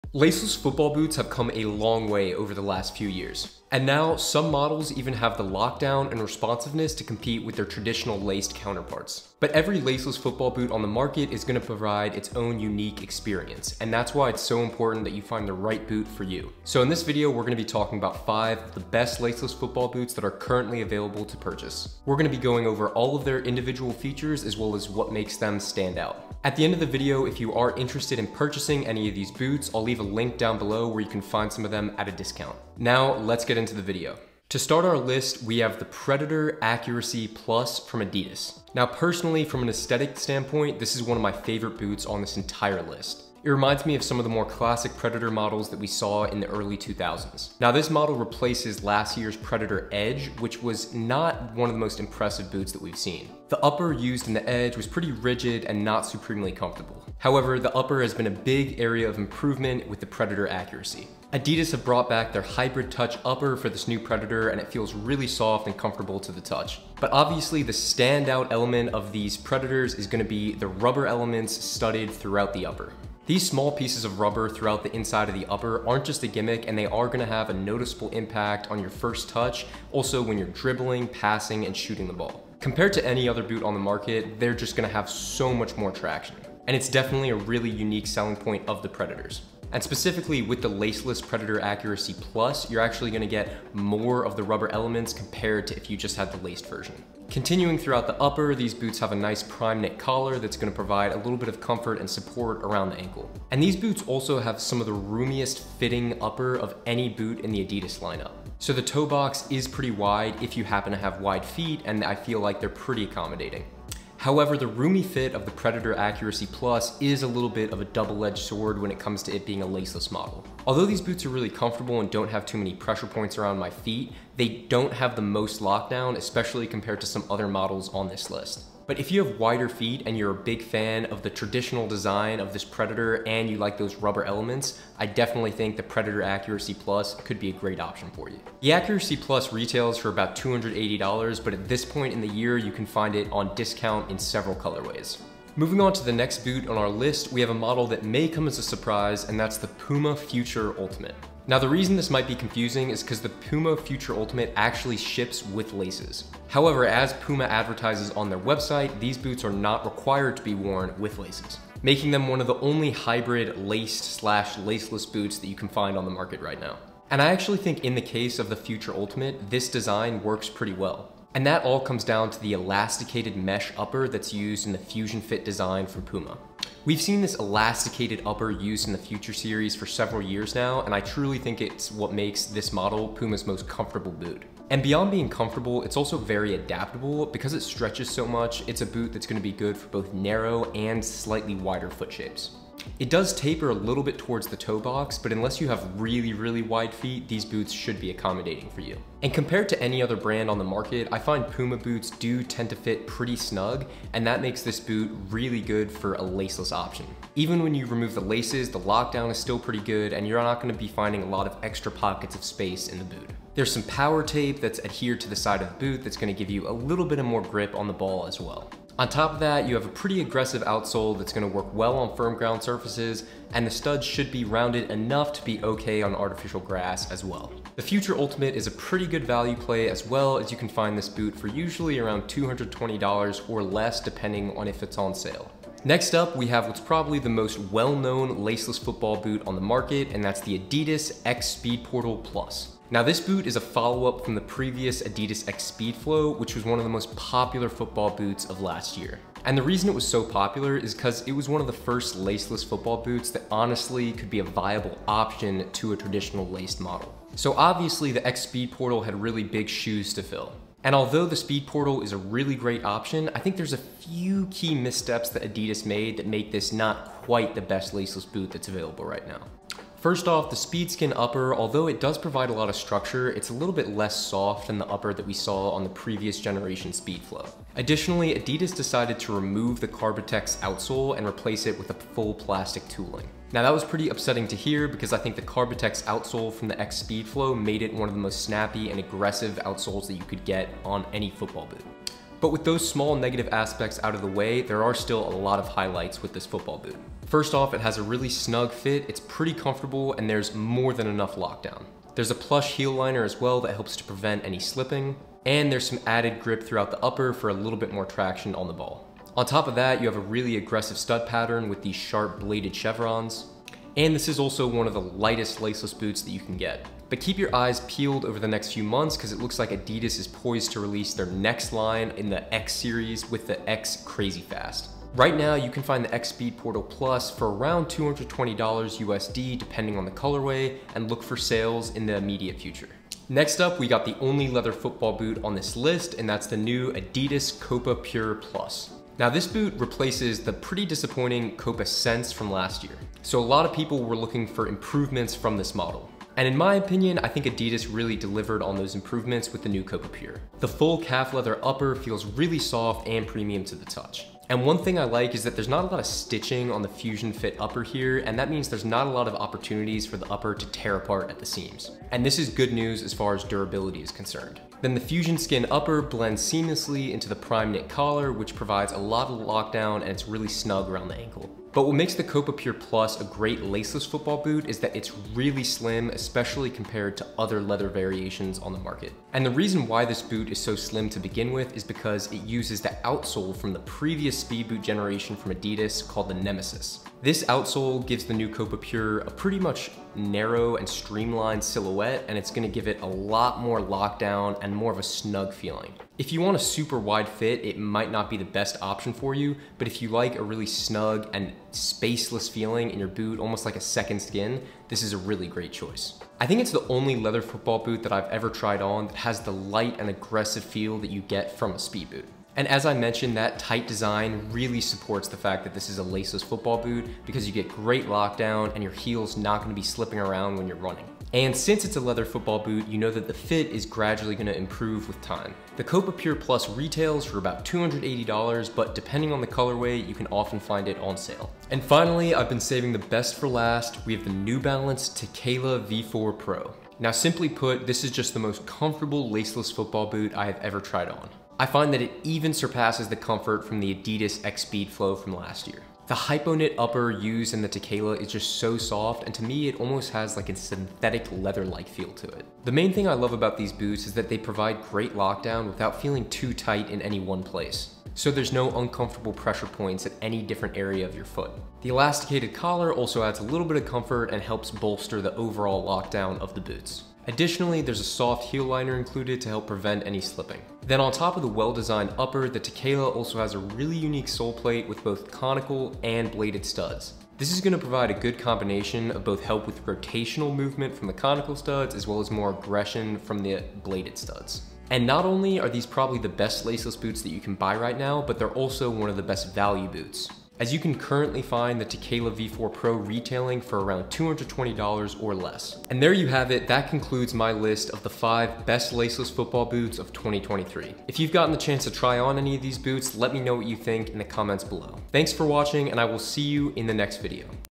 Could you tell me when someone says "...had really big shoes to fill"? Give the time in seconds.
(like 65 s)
259 s.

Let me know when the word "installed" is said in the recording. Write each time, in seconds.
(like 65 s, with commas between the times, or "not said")
not said.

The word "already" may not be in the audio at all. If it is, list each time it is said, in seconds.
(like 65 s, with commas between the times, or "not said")
not said.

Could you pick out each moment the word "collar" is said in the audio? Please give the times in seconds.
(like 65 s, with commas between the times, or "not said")
99 s, 367 s, 462 s.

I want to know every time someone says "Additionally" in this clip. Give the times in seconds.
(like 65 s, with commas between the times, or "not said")
277 s, 467 s.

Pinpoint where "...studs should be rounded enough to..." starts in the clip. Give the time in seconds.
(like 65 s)
223 s.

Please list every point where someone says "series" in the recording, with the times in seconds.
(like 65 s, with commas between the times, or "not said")
179 s, 322 s.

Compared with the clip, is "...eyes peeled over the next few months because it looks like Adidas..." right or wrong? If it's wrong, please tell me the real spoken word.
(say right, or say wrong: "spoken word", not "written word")
right.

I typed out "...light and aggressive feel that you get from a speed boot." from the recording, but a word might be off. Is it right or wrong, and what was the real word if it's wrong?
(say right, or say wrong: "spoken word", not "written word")
right.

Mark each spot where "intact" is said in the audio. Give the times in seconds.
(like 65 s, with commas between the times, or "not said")
not said.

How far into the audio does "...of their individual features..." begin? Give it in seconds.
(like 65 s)
23 s.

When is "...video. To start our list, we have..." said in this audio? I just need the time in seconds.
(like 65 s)
33 s.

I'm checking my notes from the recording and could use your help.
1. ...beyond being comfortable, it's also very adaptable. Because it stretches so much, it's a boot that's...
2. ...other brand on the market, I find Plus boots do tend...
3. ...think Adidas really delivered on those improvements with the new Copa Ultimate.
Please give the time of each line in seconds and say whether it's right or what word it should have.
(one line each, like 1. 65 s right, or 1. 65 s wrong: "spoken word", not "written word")
1. 184 s right
2. 200 s wrong: "Puma", not "Plus"
3. 347 s wrong: "Pure", not "Ultimate".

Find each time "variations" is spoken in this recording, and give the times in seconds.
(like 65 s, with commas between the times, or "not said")
377 s.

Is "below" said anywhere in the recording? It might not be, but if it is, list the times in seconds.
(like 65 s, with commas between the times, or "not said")
30 s, 504 s.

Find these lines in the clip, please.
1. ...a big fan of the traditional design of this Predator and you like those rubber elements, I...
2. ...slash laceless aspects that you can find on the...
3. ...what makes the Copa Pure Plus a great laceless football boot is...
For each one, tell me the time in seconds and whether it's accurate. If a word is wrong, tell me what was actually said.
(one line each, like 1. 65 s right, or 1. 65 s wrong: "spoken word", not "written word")
1. 130 s right
2. 164 s wrong: "boots", not "aspects"
3. 371 s right.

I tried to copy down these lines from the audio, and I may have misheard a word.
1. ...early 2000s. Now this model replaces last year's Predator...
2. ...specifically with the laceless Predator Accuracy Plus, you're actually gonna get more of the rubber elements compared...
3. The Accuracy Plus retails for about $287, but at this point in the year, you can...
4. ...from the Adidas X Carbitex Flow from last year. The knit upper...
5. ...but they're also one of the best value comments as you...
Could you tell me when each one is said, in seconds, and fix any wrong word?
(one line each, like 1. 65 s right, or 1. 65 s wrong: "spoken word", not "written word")
1. 46 s right
2. 89 s right
3. 138 s wrong: "280", not "287"
4. 443 s wrong: "Speed", not "Carbitex"
5. 488 s wrong: "boots", not "comments".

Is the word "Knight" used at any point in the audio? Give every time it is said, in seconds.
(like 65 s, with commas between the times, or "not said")
not said.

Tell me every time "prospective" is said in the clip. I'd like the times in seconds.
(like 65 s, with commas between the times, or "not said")
not said.